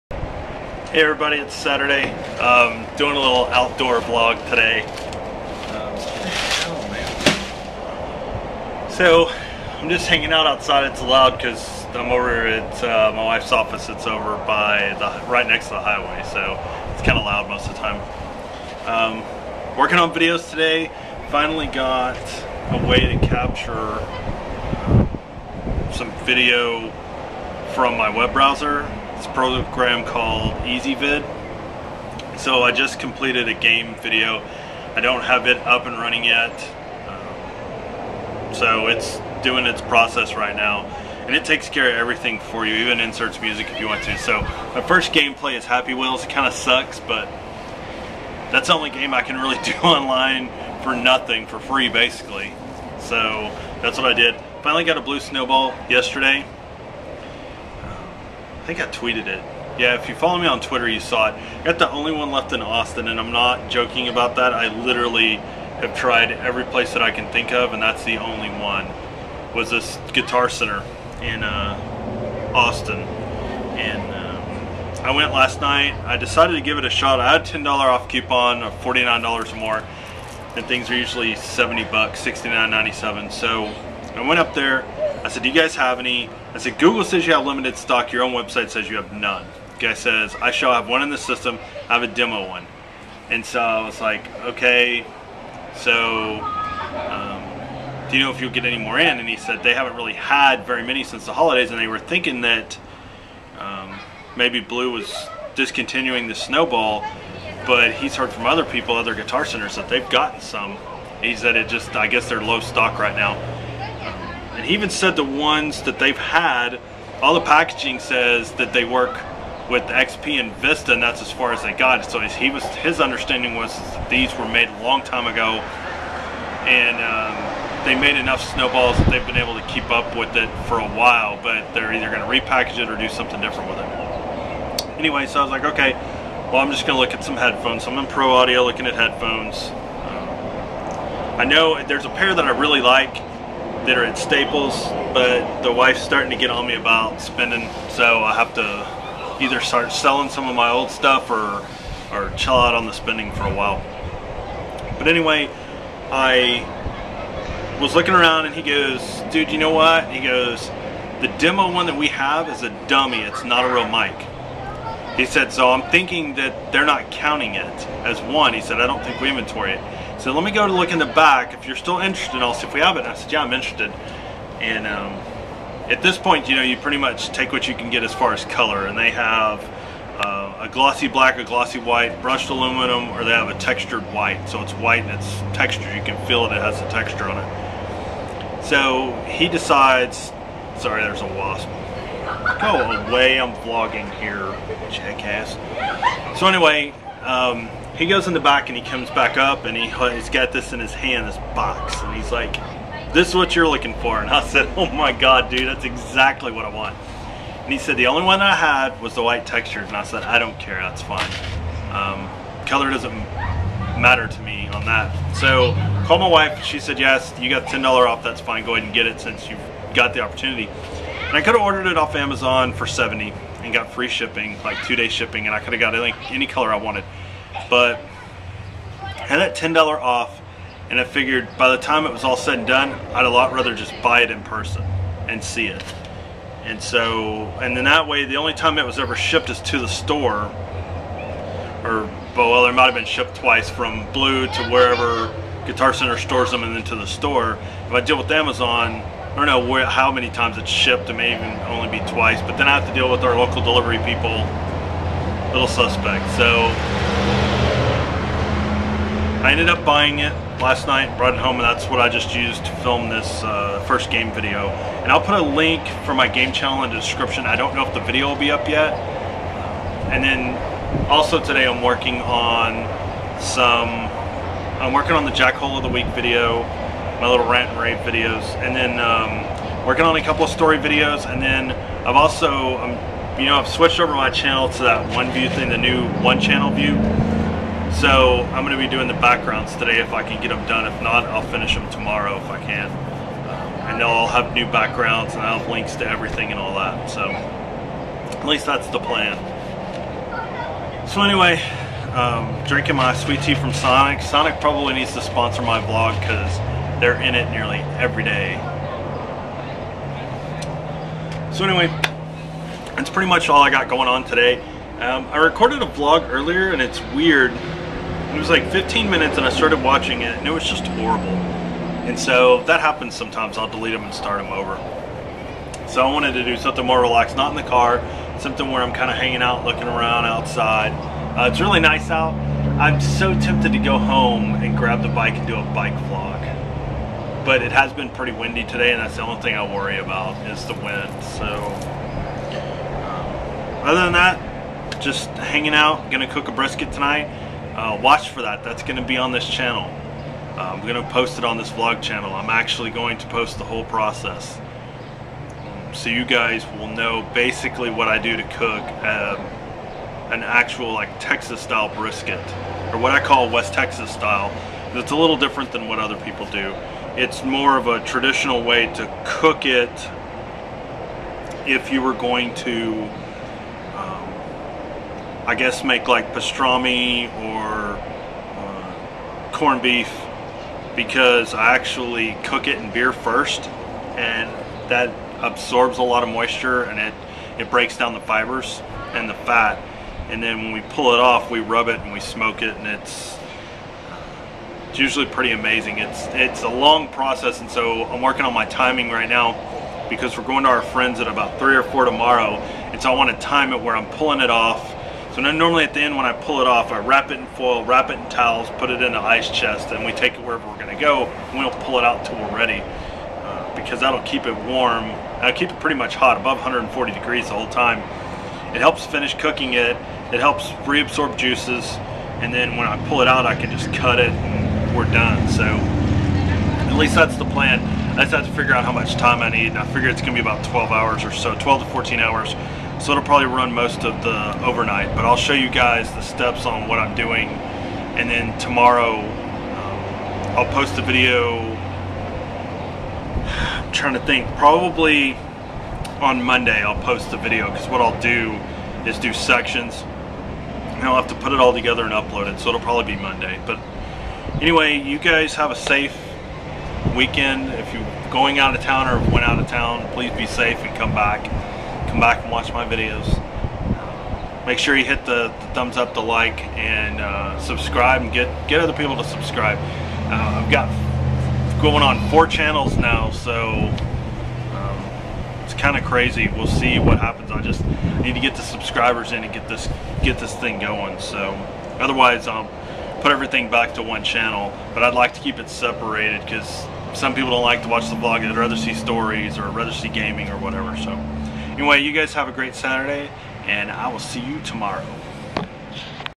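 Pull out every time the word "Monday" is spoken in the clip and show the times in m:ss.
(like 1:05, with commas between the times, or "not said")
7:26, 7:33.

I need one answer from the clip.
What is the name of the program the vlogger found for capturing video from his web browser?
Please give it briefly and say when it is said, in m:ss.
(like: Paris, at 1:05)
Ezvid, at 0:30.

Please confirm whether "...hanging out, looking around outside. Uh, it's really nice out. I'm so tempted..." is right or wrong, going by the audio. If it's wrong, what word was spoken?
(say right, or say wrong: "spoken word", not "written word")
right.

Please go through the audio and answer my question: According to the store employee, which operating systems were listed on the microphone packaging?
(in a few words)
XP and Vista.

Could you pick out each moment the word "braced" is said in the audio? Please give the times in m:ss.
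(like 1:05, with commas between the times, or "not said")
not said.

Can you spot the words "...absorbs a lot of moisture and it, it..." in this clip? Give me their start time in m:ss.
6:25.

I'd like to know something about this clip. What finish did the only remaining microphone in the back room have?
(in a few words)
white textured.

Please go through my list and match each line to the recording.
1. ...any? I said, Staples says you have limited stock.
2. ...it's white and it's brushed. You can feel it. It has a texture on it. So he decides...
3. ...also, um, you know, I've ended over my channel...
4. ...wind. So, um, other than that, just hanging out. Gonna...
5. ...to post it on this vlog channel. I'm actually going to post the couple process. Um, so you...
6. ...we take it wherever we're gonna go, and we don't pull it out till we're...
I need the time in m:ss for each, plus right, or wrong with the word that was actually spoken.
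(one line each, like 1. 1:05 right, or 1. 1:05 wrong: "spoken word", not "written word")
1. 1:25 wrong: "Google", not "Staples"
2. 3:04 wrong: "textured", not "brushed"
3. 4:42 wrong: "switched", not "ended"
4. 5:40 right
5. 5:51 wrong: "whole", not "couple"
6. 6:50 right.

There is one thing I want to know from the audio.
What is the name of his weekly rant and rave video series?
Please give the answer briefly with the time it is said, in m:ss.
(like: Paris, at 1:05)
Jackhole of the Week, at 4:35.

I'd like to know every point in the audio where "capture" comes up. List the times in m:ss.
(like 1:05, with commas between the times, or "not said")
0:23.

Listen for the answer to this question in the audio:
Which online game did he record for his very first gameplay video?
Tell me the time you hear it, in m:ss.
0:45.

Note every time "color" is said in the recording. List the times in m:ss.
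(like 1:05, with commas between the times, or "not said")
2:58, 3:32, 3:46.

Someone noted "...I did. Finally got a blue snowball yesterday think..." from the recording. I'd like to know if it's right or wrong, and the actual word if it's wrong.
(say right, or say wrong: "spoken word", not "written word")
right.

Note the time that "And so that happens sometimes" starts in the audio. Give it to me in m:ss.
5:22.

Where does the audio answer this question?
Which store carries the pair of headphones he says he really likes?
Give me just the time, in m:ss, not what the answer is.
2:24.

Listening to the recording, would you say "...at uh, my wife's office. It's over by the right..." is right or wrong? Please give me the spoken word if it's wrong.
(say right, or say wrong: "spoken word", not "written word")
right.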